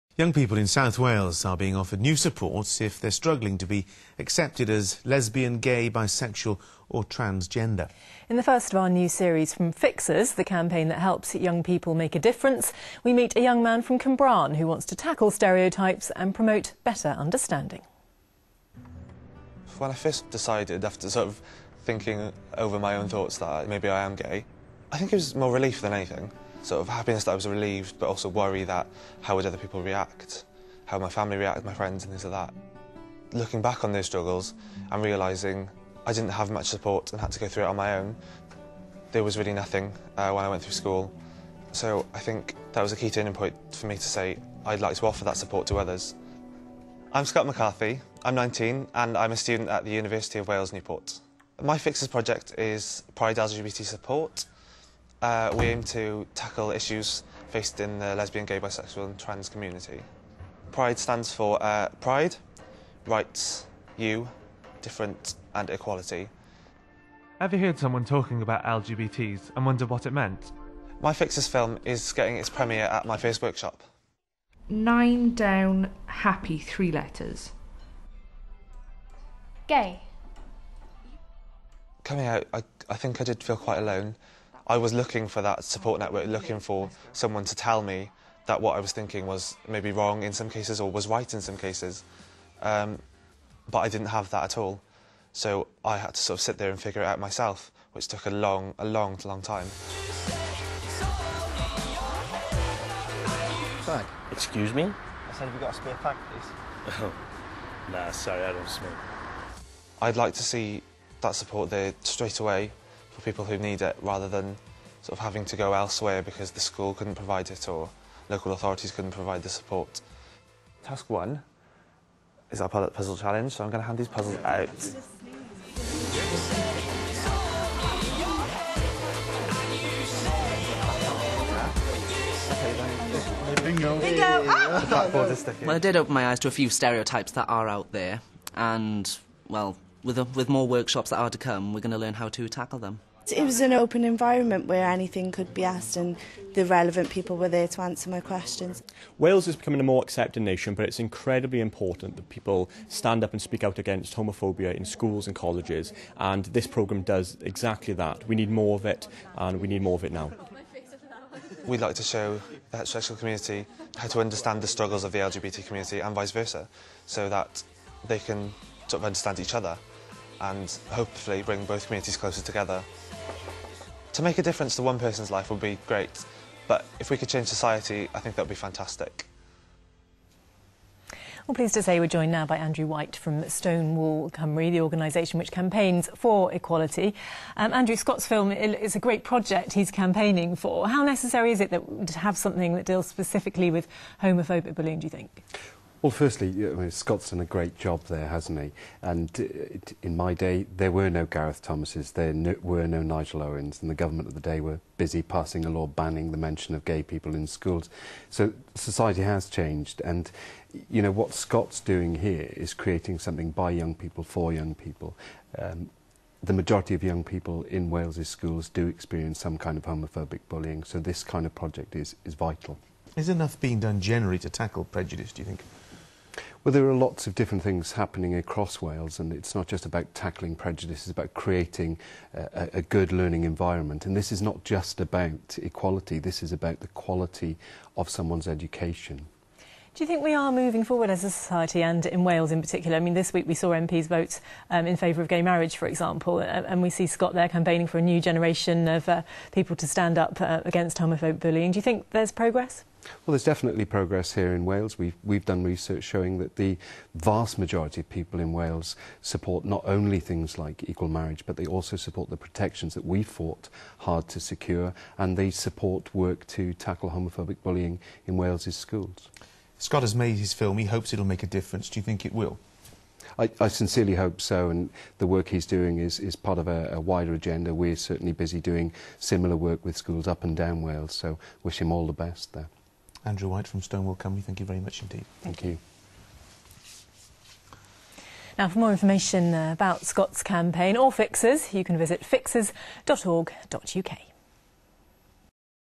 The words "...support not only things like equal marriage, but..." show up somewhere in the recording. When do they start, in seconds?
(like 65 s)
259 s.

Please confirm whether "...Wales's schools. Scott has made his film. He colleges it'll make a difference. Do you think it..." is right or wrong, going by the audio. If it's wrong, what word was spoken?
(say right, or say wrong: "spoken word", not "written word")
wrong: "hopes", not "colleges".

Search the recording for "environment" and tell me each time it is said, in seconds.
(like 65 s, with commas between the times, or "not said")
144 s, 233 s.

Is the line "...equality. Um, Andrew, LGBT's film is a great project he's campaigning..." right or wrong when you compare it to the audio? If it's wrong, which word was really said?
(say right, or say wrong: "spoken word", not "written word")
wrong: "Scott", not "LGBT".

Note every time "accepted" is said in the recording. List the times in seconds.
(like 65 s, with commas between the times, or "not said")
4 s, 150 s.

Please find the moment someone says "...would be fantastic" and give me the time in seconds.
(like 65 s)
178 s.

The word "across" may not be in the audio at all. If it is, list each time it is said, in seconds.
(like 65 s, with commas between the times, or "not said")
228 s.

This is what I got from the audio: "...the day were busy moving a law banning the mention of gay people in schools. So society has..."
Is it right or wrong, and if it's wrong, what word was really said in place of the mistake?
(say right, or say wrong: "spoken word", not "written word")
wrong: "passing", not "moving".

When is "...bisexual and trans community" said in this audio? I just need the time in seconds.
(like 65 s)
58 s.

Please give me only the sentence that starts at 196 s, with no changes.
Well, firstly, Scott's done a great job there, hasn't he?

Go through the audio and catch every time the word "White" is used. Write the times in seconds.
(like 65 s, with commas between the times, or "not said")
182 s, 283 s.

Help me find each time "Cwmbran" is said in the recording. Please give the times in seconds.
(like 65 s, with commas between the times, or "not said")
13 s.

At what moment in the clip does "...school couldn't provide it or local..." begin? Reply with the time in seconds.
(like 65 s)
116 s.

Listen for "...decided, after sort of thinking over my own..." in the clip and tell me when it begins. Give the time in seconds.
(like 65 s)
20 s.